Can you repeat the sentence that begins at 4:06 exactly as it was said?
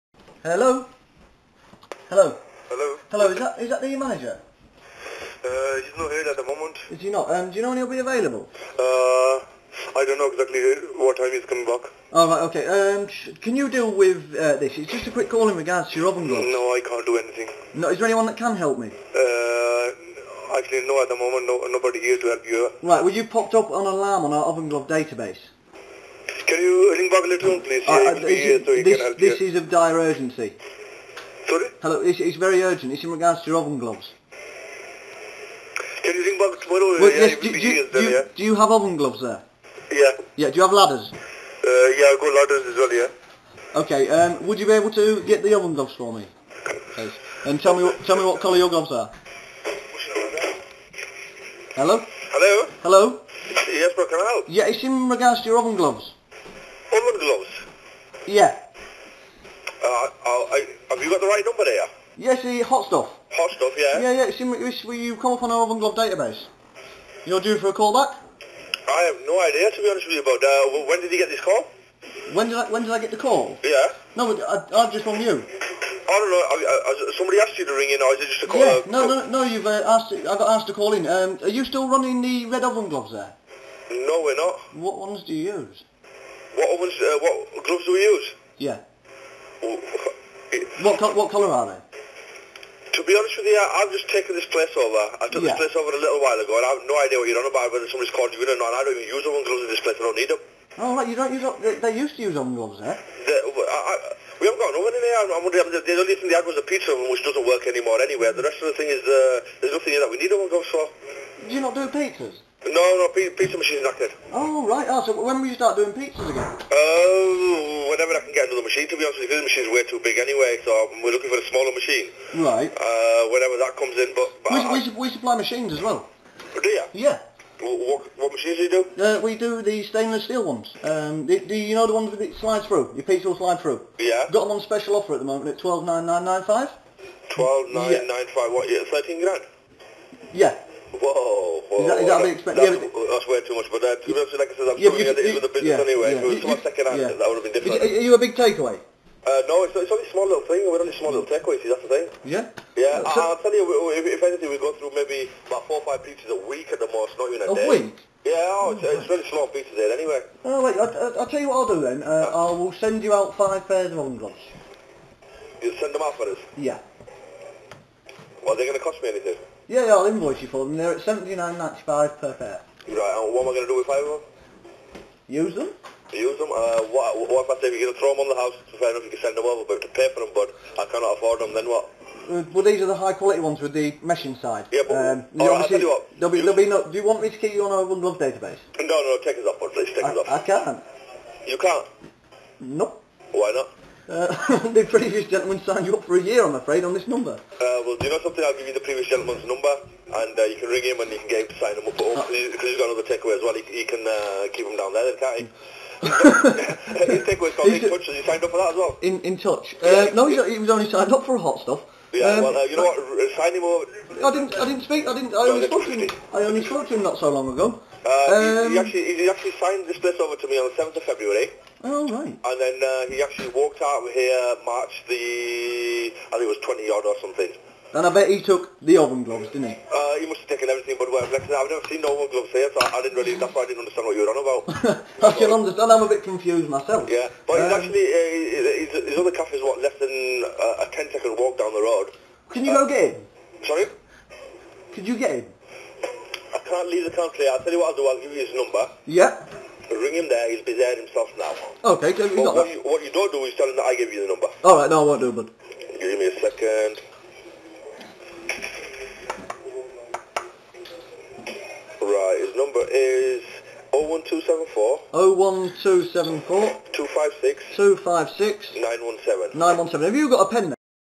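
can't leave the country, I'll tell you what I'll do, I'll give you his number.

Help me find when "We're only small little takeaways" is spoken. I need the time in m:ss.
2:30.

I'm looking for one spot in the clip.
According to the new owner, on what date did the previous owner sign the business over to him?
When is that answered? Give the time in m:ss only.
3:40.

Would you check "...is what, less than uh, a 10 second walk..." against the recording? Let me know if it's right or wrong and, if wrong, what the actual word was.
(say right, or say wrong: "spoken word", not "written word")
right.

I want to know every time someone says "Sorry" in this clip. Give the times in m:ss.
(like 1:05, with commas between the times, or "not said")
0:31, 4:03.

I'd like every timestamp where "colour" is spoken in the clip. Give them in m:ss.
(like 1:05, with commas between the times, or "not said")
0:48, 1:31.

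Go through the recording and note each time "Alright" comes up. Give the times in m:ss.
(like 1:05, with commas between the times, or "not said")
4:14.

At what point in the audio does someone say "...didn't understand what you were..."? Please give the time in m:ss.
3:53.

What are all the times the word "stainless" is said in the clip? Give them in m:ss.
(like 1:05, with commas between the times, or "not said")
2:09.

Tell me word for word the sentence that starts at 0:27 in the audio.
Uh, uh this, uh, so this, this is of dire urgency.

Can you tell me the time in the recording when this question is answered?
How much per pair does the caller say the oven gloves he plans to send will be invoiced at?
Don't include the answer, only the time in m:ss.
2:51.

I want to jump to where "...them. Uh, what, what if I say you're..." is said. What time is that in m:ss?
2:56.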